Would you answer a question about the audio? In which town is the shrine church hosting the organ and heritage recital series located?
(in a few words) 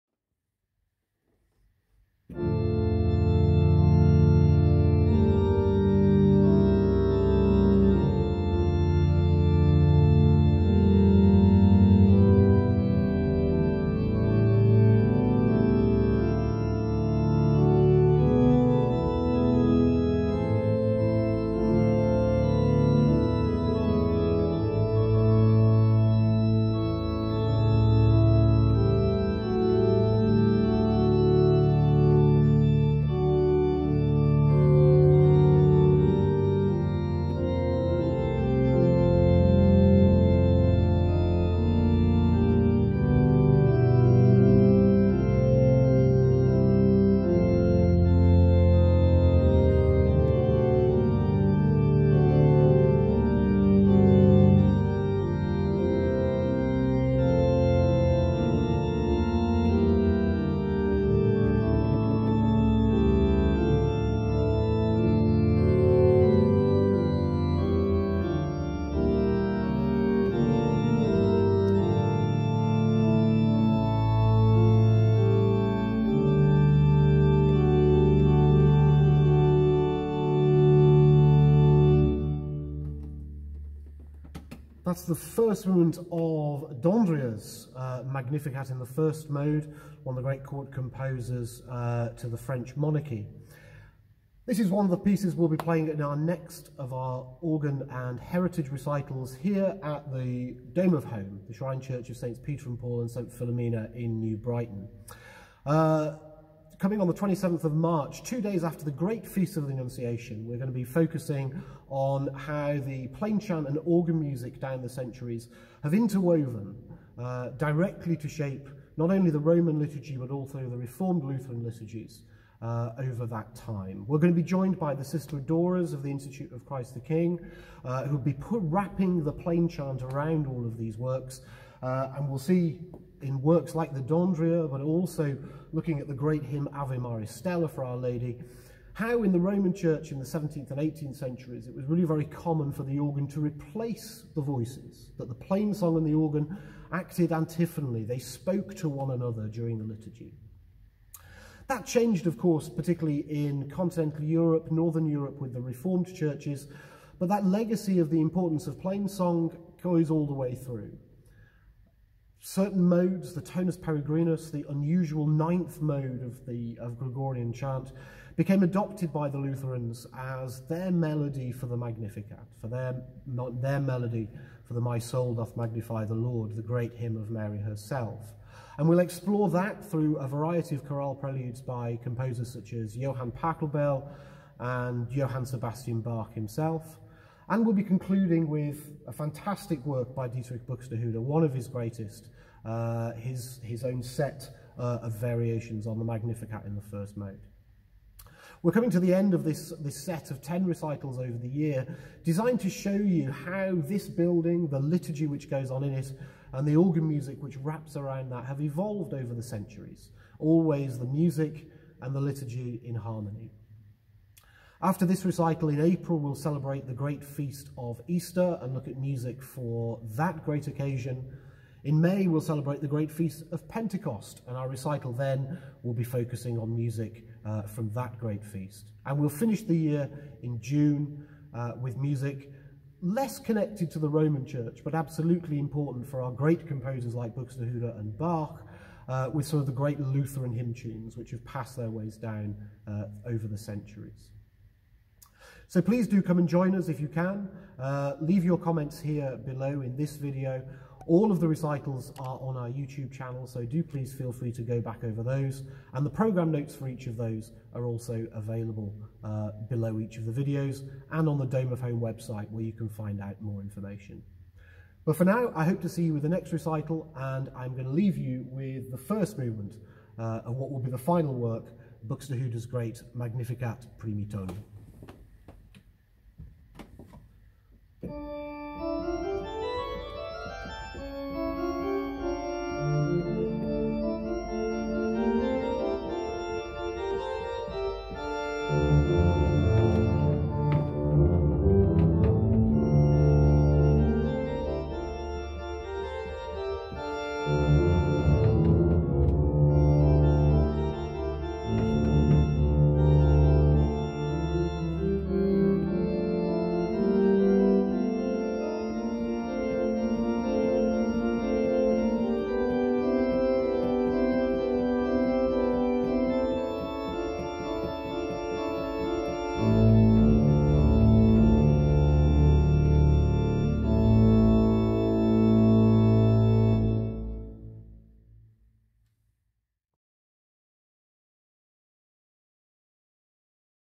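New Brighton.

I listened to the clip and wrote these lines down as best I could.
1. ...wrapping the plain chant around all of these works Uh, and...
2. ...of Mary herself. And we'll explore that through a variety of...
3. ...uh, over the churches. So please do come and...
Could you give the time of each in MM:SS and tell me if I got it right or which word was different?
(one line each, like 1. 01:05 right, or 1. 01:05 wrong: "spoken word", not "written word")
1. 02:08 right
2. 02:57 right
3. 04:02 wrong: "centuries", not "churches".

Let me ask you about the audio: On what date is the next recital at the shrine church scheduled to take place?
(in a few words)
27 March.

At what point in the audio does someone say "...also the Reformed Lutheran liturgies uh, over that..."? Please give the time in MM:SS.
02:00.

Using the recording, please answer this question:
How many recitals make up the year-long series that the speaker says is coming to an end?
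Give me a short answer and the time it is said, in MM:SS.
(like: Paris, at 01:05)
10, at 03:20.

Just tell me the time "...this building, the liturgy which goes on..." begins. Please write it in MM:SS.
03:23.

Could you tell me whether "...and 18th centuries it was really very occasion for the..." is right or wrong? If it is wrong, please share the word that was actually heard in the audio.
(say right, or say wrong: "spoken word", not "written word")
wrong: "common", not "occasion".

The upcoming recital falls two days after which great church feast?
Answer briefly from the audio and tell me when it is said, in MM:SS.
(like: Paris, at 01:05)
The Annunciation, at 01:49.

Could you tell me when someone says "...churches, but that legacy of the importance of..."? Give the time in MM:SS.
02:36.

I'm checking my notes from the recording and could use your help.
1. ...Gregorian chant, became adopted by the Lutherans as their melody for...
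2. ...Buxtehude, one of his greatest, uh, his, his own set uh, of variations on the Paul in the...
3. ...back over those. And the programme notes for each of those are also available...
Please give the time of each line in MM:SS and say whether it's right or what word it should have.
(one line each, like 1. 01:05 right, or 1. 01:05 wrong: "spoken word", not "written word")
1. 02:46 right
2. 03:10 wrong: "Magnificat", not "Paul"
3. 04:14 right.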